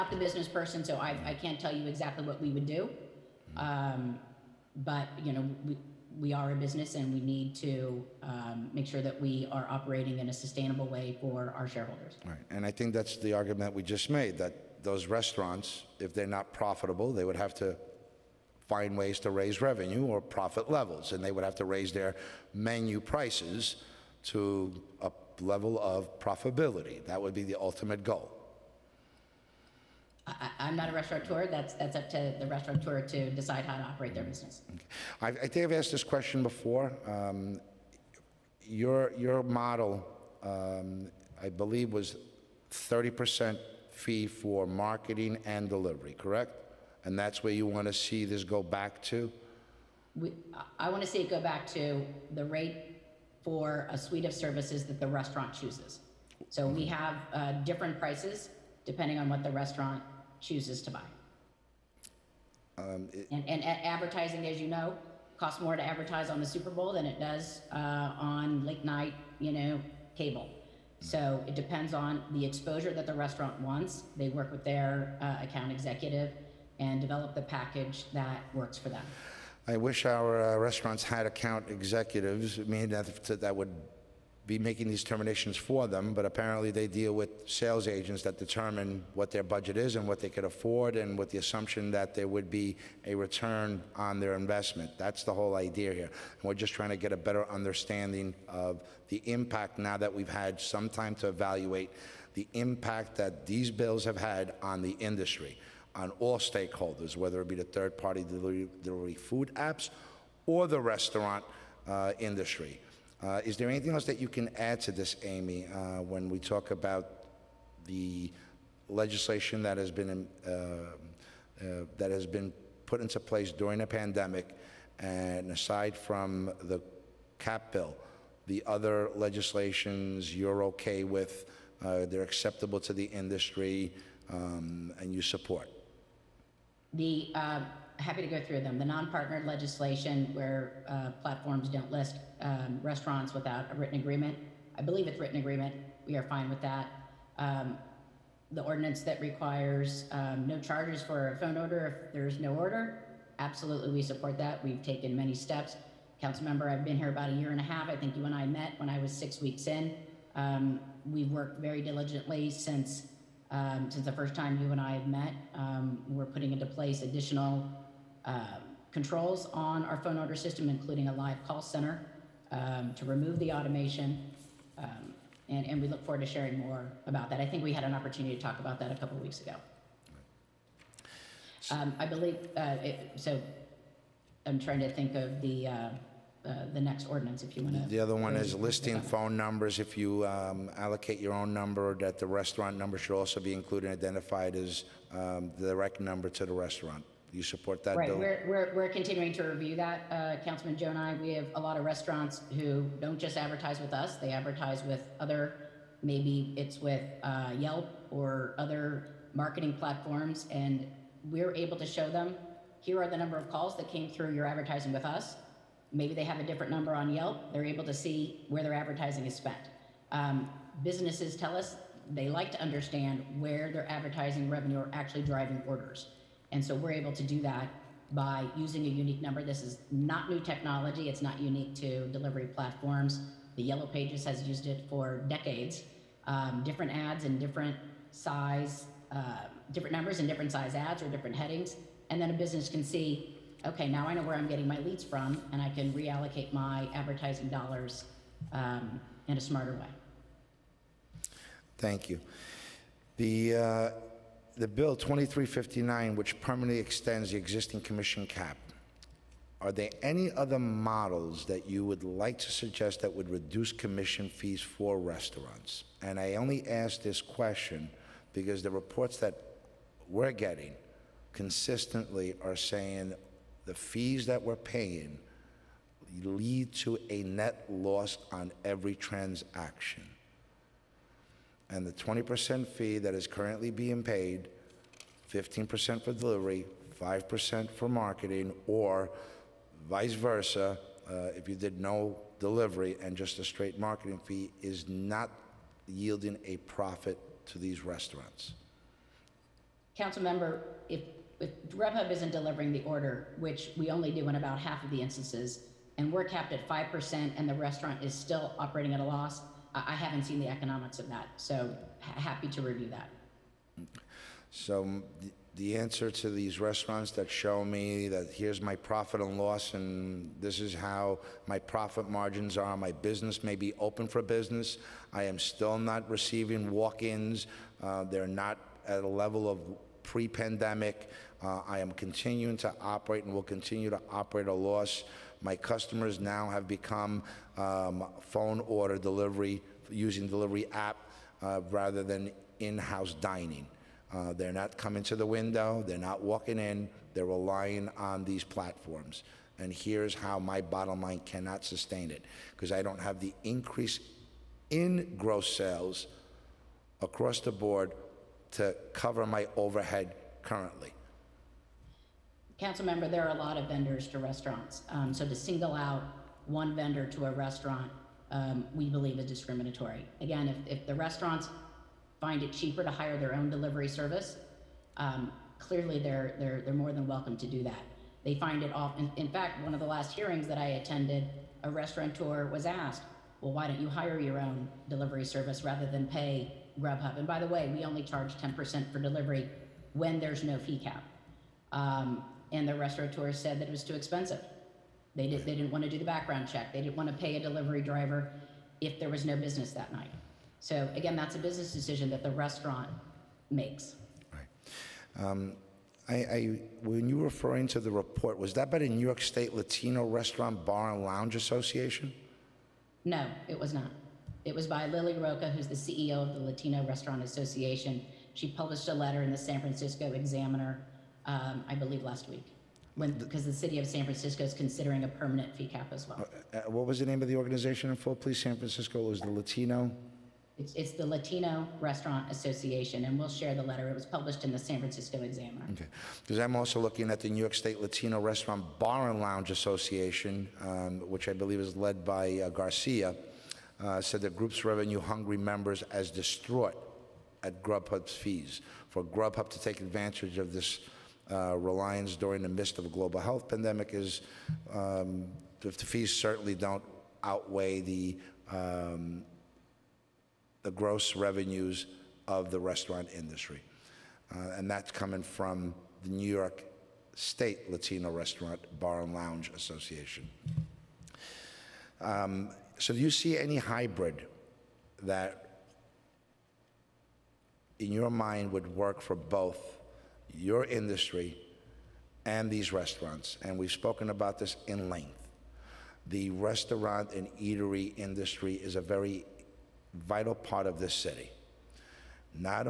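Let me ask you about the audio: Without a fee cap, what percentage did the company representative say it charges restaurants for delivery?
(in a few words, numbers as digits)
10%.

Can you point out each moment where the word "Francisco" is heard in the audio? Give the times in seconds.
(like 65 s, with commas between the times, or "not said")
419 s, 424 s, 428 s, 434 s.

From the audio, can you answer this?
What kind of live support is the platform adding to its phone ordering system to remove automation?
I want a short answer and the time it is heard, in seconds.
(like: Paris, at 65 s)
live call center, at 171 s.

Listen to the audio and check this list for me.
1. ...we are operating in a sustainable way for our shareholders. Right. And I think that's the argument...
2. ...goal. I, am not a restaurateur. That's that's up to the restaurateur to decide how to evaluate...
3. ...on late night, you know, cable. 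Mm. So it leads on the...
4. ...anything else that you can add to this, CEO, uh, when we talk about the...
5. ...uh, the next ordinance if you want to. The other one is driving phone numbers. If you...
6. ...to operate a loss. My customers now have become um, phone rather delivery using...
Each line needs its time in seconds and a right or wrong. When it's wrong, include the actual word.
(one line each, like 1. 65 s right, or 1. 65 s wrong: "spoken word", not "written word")
1. 9 s right
2. 28 s wrong: "operate", not "evaluate"
3. 68 s wrong: "depends", not "leads"
4. 113 s wrong: "Amy", not "CEO"
5. 186 s wrong: "listing", not "driving"
6. 333 s wrong: "order", not "rather".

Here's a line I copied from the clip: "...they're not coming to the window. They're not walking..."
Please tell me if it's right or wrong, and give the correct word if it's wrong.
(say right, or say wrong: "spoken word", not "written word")
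right.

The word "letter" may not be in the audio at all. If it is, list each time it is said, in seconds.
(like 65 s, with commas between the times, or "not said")
418 s, 433 s.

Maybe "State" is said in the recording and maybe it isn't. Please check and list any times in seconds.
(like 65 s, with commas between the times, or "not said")
409 s, 437 s, 467 s.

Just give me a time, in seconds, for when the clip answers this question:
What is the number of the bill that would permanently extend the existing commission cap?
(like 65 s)
254 s.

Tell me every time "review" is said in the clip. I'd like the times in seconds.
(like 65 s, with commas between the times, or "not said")
199 s, 312 s.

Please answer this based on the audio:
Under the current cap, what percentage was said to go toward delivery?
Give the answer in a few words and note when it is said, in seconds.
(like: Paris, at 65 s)
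15%, at 285 s.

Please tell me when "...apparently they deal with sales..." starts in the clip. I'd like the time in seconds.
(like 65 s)
86 s.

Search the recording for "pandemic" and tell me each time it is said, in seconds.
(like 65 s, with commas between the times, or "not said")
123 s, 330 s, 453 s.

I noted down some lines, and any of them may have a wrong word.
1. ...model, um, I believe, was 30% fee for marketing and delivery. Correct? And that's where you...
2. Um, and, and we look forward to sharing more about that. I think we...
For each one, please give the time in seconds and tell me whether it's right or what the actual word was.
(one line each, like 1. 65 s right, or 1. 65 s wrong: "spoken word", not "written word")
1. 39 s right
2. 174 s right.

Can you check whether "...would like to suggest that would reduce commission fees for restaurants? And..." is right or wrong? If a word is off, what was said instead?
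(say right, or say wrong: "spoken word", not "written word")
right.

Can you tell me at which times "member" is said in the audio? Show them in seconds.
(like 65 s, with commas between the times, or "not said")
156 s, 300 s, 362 s, 445 s.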